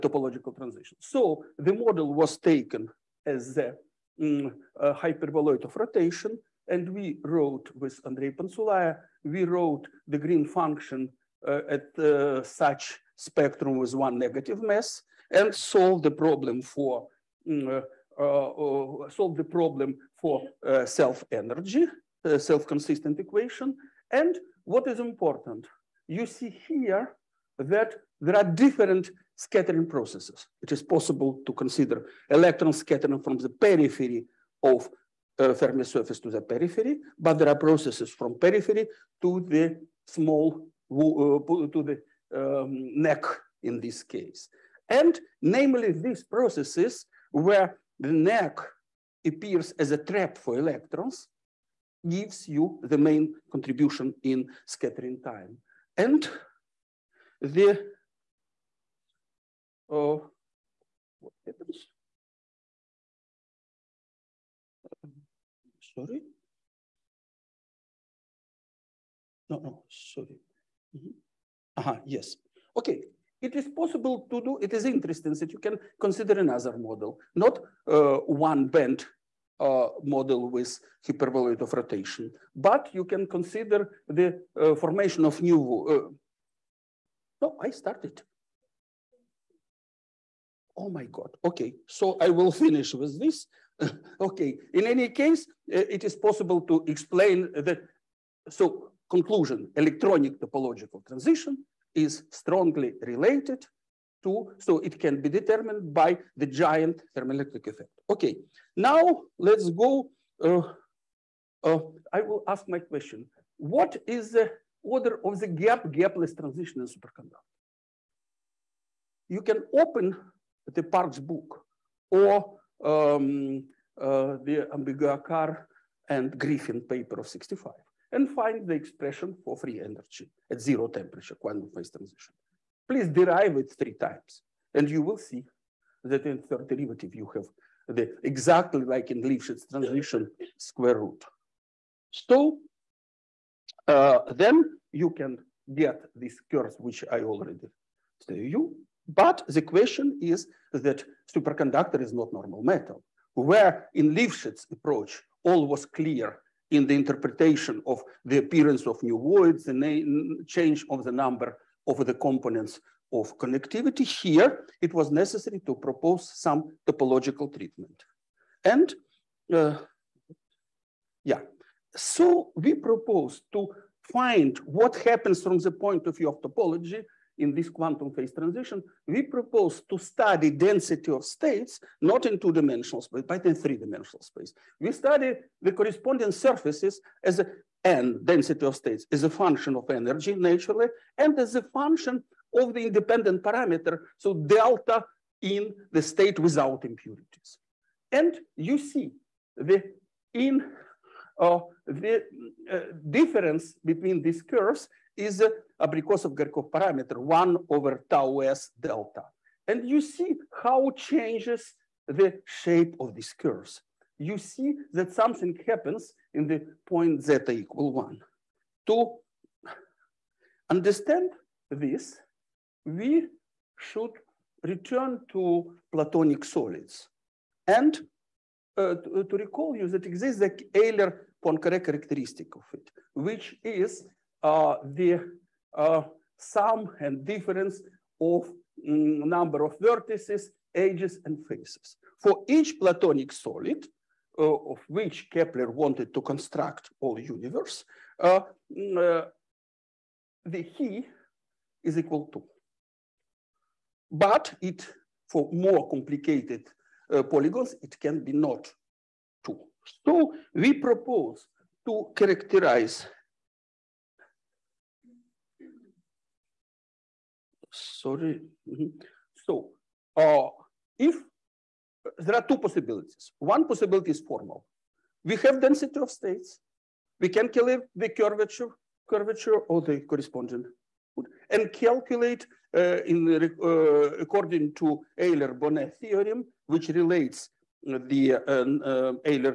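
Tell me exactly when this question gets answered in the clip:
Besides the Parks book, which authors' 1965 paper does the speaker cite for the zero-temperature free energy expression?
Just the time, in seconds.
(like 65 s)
124 s.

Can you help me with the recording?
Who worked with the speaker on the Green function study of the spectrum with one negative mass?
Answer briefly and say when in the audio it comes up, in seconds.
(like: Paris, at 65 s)
Andrei Pantsulaya, at 8 s.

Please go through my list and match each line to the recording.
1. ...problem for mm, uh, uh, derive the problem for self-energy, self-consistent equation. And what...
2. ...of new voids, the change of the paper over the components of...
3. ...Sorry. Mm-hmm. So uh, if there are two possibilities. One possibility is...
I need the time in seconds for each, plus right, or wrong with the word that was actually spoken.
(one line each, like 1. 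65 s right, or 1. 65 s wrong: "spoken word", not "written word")
1. 16 s wrong: "solve", not "derive"
2. 158 s wrong: "number", not "paper"
3. 267 s right.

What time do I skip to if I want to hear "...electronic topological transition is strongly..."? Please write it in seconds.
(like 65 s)
99 s.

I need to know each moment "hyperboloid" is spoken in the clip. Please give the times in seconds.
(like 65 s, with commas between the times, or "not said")
4 s, 81 s.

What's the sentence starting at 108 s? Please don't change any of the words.
Okay, now let's go, uh, uh, I will ask my question.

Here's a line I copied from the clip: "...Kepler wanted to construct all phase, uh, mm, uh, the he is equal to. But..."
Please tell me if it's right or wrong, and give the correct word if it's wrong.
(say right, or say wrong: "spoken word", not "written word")
wrong: "universe", not "phase".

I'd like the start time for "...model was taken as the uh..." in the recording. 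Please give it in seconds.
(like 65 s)
1 s.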